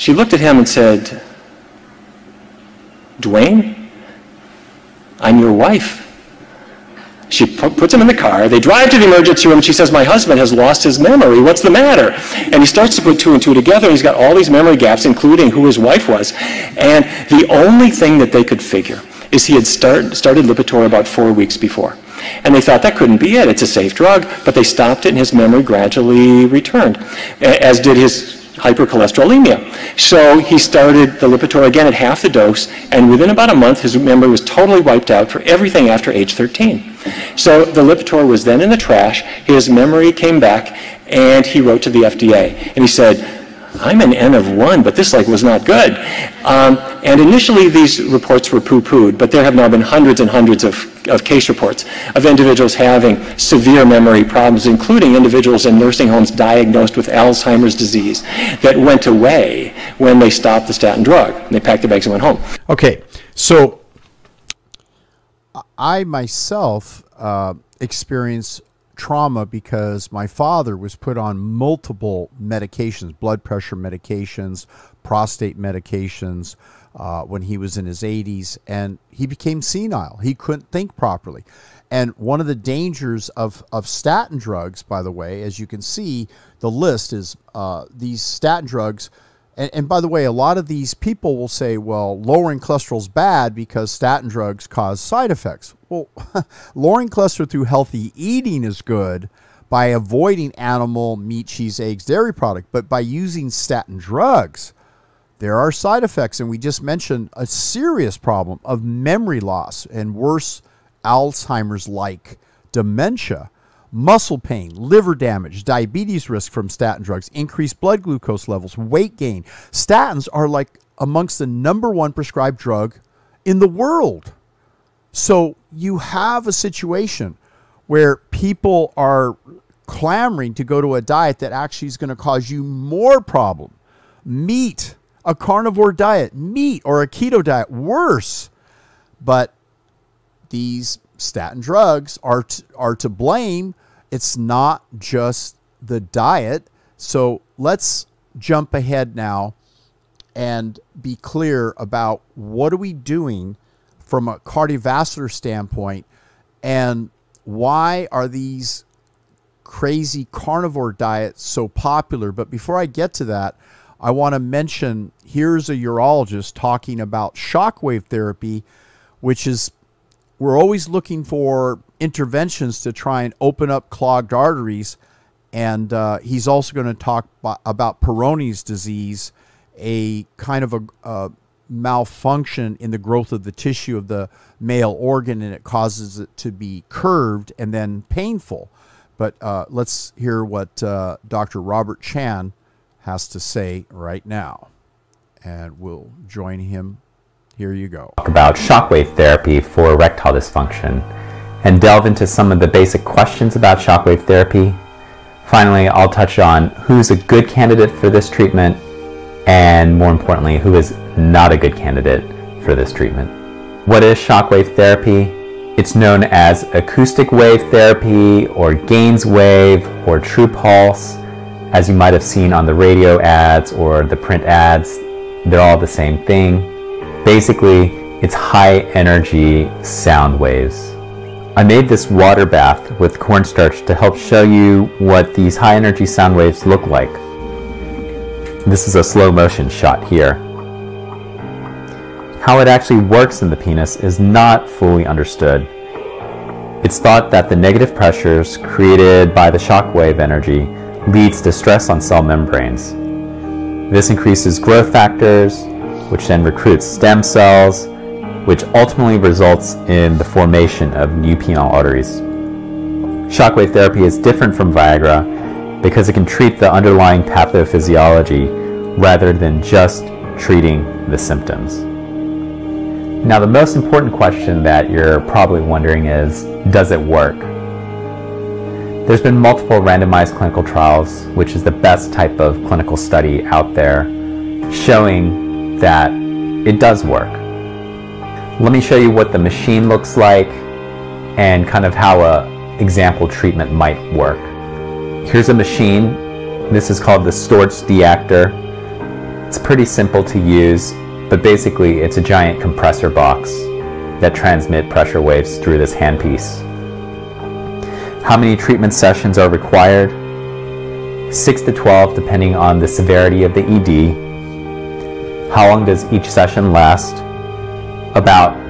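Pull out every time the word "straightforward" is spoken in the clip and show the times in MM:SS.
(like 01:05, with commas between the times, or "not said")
not said.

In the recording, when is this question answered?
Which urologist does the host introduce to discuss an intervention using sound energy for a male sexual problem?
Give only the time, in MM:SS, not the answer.
03:11.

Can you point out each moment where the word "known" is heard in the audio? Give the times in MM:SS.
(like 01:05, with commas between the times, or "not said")
03:35.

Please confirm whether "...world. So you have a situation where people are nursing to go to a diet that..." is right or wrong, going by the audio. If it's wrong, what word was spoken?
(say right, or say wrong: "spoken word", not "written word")
wrong: "clamoring", not "nursing".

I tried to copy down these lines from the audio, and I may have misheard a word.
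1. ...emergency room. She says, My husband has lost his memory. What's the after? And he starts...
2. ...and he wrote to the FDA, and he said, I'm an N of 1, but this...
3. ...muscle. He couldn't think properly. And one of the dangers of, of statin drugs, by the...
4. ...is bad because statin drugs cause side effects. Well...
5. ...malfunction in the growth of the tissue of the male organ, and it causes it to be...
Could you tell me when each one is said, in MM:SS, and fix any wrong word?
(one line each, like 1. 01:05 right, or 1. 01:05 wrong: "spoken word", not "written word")
1. 00:09 wrong: "matter", not "after"
2. 00:41 right
3. 01:19 wrong: "senile", not "muscle"
4. 01:32 right
5. 03:01 right.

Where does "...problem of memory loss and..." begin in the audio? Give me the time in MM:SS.
01:48.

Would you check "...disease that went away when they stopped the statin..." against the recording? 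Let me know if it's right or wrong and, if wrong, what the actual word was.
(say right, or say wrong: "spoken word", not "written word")
right.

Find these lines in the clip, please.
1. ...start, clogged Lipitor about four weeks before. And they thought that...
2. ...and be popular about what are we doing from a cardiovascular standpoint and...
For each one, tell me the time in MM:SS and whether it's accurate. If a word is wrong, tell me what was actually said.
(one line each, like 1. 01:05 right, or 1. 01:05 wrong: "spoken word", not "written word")
1. 00:19 wrong: "started", not "clogged"
2. 02:30 wrong: "clear", not "popular".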